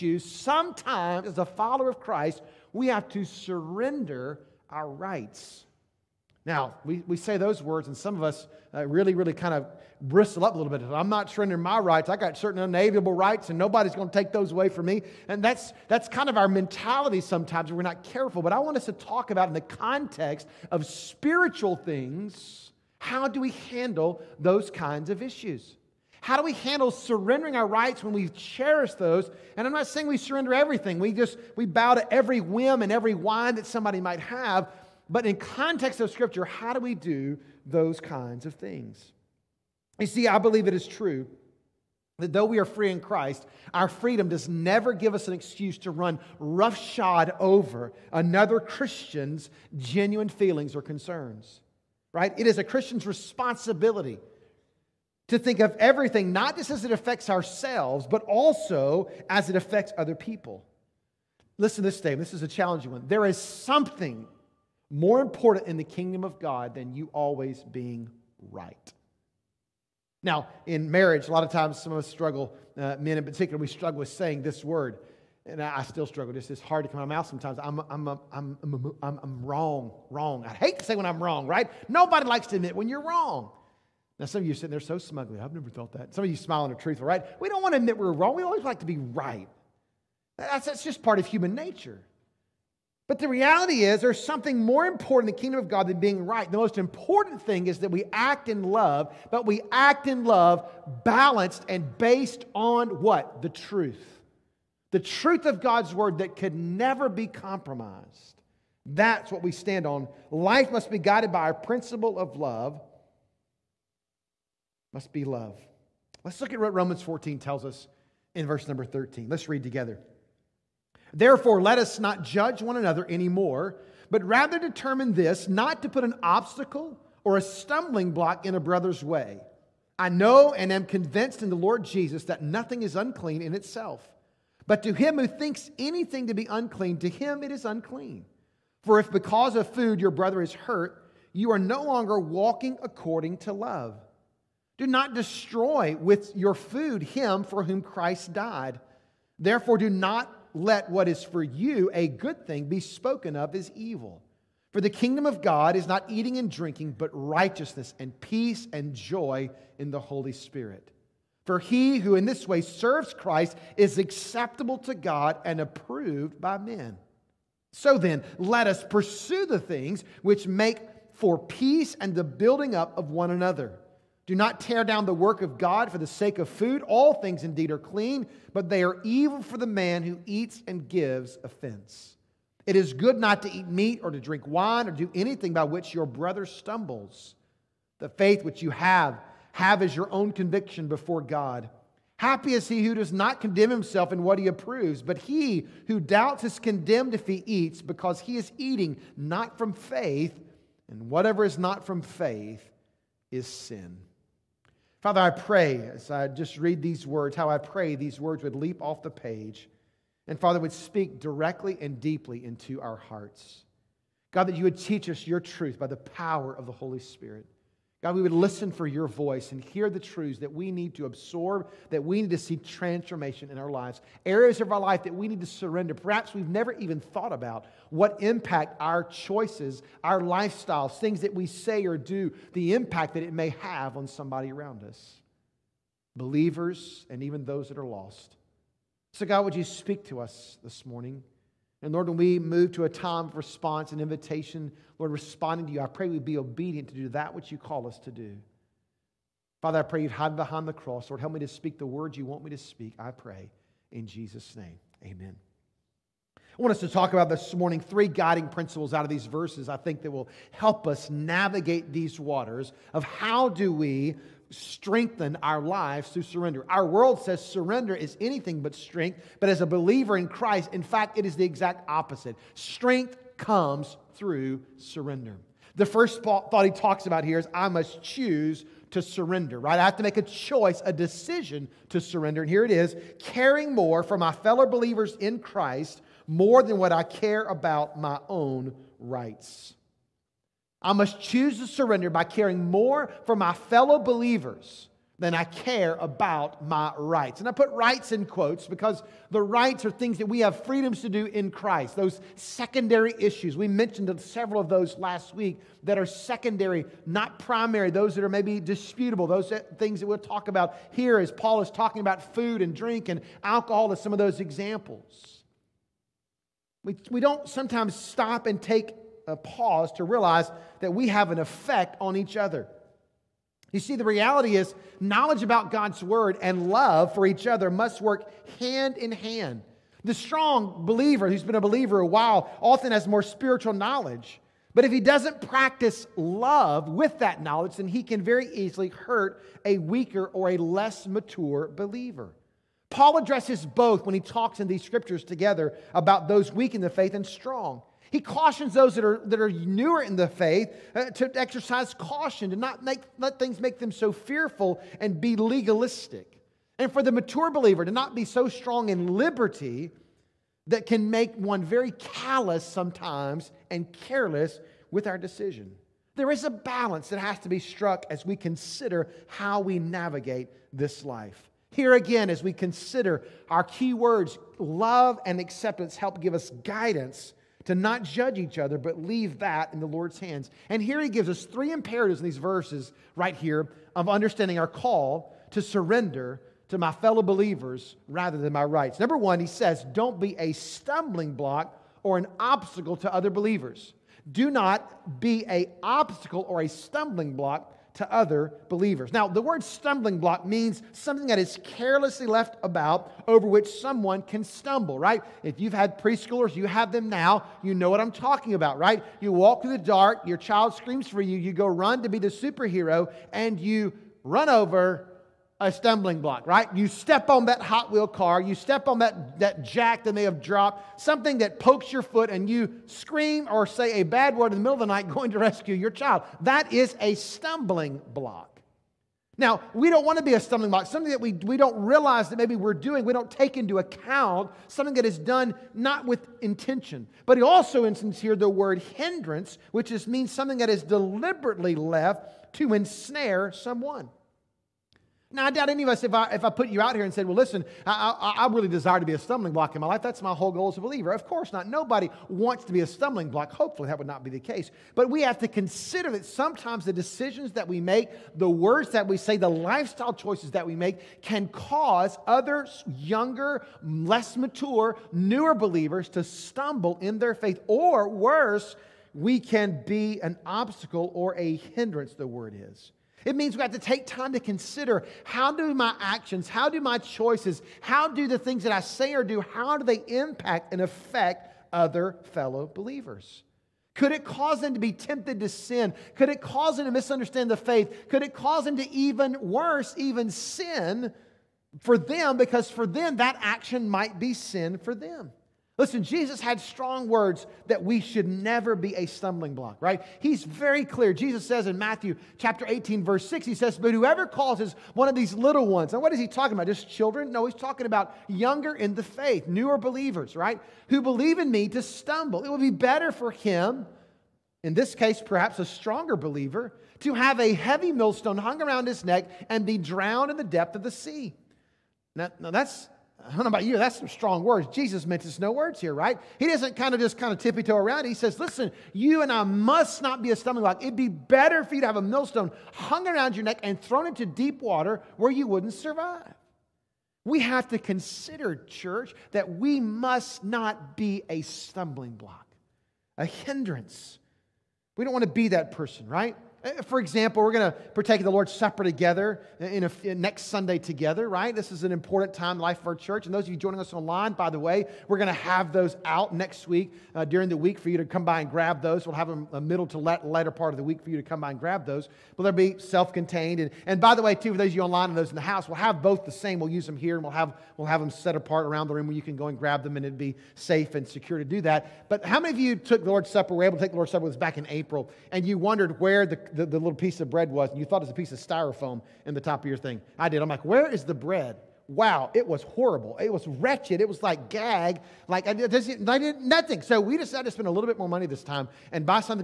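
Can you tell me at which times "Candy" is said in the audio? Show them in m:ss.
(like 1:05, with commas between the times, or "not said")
not said.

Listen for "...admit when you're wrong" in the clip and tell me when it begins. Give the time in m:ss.
1:22.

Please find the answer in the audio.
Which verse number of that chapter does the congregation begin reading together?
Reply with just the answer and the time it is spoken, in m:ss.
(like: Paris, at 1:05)
13, at 1:58.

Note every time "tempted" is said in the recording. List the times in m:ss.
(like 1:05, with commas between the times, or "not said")
8:04.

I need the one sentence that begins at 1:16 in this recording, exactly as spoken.
This is hard to come out of my mouth sometimes.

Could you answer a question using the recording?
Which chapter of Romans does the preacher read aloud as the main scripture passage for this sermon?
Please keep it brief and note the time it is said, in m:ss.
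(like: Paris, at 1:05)
Romans 14, at 1:56.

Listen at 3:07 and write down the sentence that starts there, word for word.
The faith which you have, have as your own conviction before God.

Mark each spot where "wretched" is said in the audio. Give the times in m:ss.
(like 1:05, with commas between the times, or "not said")
9:43.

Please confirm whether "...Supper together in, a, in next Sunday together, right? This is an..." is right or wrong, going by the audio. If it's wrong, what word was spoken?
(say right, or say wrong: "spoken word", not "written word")
right.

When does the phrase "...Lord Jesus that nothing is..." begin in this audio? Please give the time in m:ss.
2:11.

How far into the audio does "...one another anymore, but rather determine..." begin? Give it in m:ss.
2:02.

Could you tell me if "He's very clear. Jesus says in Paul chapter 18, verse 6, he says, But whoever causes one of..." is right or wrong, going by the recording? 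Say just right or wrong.
wrong.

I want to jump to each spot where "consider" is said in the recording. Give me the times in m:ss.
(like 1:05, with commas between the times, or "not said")
6:08, 6:12, 7:35, 7:54, 8:57.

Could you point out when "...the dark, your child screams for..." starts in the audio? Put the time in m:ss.
6:49.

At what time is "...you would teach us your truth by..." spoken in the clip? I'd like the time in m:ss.
3:34.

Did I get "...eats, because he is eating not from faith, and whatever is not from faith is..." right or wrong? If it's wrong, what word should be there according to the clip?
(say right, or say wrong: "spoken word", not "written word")
right.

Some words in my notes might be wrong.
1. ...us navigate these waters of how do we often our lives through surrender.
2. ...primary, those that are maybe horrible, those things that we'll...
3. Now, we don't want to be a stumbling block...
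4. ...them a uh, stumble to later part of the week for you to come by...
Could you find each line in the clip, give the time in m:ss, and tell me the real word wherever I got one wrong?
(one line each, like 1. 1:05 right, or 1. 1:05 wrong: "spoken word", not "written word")
1. 4:20 wrong: "strengthen", not "often"
2. 5:07 wrong: "disputable", not "horrible"
3. 7:09 right
4. 9:19 wrong: "middle", not "stumble".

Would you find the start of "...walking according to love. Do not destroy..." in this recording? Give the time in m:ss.
2:22.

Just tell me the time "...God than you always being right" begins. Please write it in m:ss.
1:06.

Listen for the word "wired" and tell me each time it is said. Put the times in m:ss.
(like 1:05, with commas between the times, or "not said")
not said.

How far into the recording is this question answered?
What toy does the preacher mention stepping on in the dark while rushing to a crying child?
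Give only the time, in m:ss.
6:57.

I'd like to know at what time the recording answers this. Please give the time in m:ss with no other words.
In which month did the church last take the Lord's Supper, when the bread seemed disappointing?
9:34.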